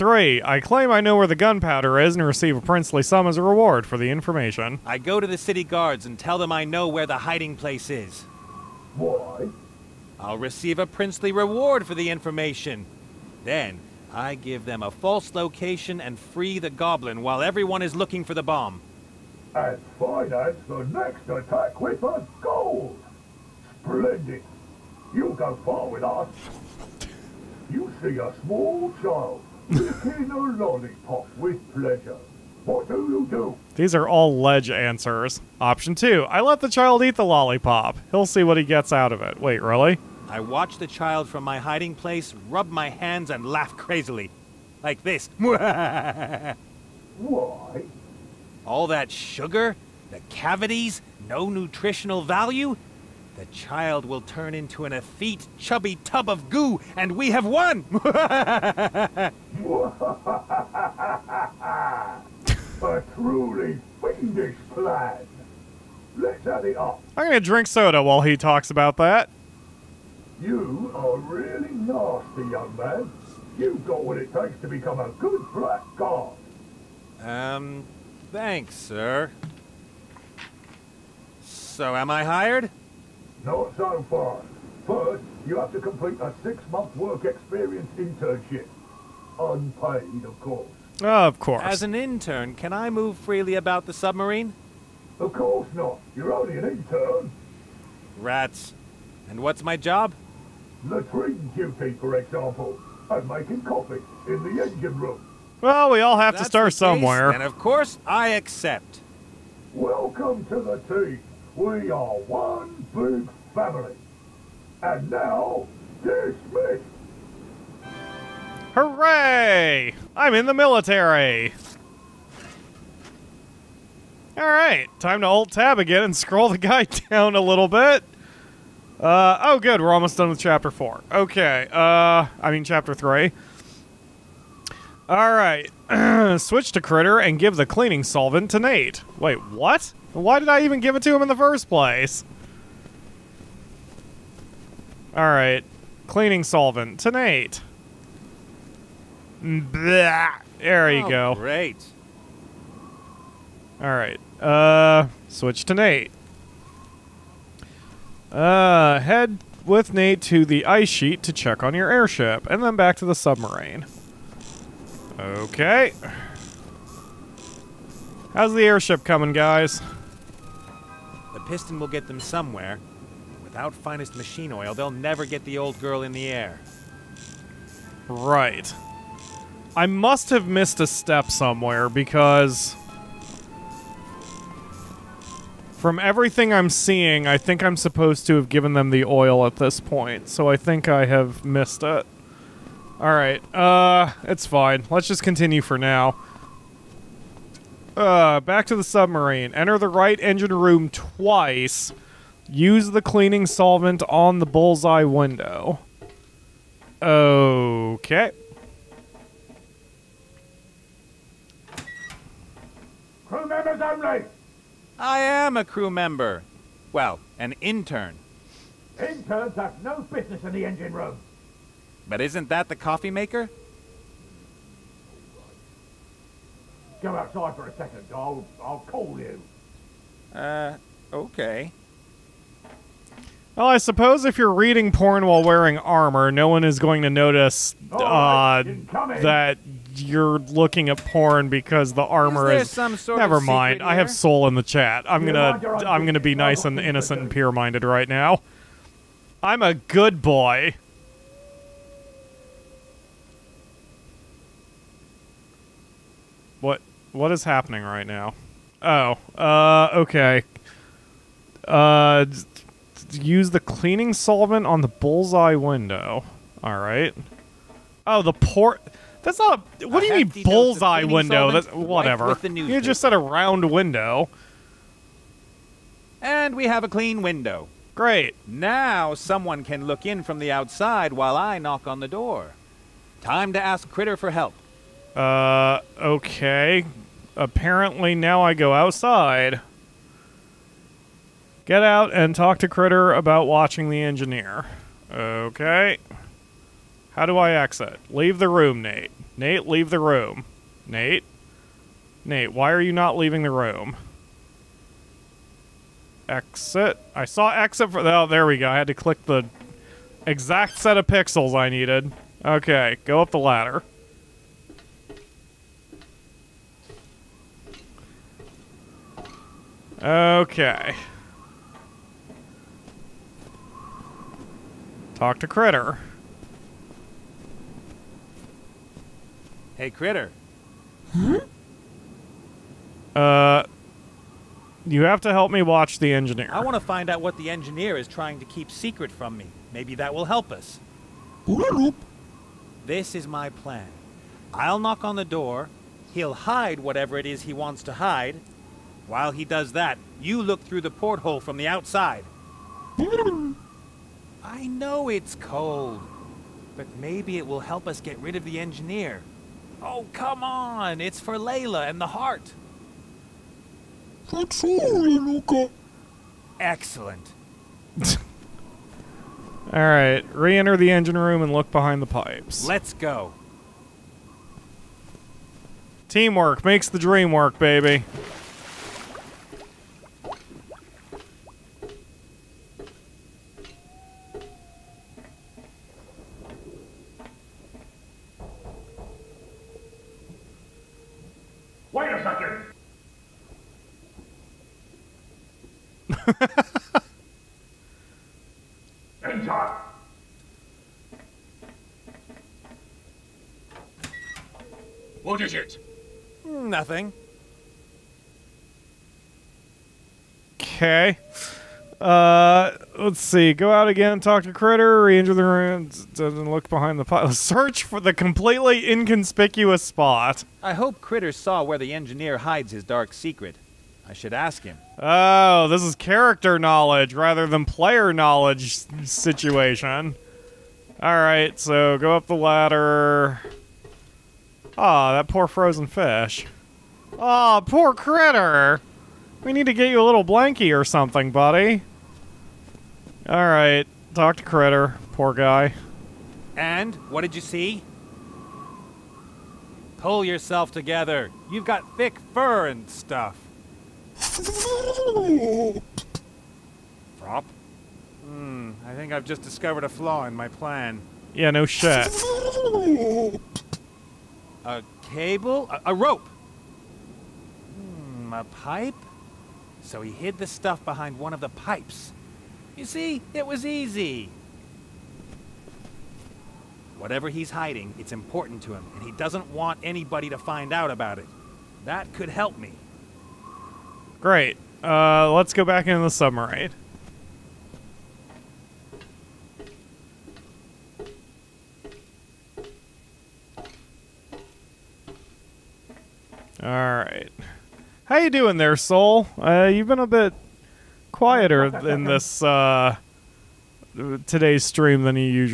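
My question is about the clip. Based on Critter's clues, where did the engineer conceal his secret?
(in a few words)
Behind one of the pipes.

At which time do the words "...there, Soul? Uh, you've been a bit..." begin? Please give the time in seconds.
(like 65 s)
498 s.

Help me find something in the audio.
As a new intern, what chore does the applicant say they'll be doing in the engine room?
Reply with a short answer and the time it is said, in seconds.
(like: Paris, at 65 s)
Making coffee, at 103 s.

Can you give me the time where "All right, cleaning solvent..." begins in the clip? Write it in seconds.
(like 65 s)
145 s.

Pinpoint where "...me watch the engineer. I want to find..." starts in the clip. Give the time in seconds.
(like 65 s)
335 s.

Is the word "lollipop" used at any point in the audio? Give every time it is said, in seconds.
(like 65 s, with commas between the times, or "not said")
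30 s, 37 s.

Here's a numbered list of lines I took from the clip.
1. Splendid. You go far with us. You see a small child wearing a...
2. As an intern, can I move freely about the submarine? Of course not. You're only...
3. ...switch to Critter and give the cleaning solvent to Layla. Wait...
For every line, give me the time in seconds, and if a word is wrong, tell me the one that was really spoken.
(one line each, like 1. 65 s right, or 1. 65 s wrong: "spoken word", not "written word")
1. 23 s wrong: "licking", not "wearing"
2. 91 s right
3. 136 s wrong: "Nate", not "Layla".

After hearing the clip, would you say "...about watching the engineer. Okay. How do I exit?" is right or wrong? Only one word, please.
right.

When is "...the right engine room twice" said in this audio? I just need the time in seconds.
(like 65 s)
199 s.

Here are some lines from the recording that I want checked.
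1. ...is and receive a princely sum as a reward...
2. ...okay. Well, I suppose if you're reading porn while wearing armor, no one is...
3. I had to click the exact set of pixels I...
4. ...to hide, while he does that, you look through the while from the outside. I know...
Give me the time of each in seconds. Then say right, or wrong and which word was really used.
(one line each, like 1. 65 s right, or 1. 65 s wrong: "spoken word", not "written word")
1. 1 s right
2. 231 s right
3. 308 s right
4. 347 s wrong: "porthole", not "while".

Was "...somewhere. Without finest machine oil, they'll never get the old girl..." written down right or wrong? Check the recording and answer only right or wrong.
right.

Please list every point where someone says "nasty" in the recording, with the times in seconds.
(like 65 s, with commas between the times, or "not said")
71 s.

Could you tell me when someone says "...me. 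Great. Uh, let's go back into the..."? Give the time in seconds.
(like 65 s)
482 s.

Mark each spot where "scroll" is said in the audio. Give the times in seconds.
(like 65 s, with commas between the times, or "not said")
126 s.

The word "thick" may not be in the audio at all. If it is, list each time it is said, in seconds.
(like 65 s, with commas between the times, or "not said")
451 s.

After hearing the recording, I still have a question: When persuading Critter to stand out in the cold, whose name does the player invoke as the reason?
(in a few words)
Layla.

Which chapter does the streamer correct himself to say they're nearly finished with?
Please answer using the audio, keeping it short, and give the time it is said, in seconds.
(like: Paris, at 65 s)
Chapter three, at 132 s.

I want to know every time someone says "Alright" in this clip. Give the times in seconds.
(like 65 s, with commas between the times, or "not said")
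192 s, 369 s, 443 s.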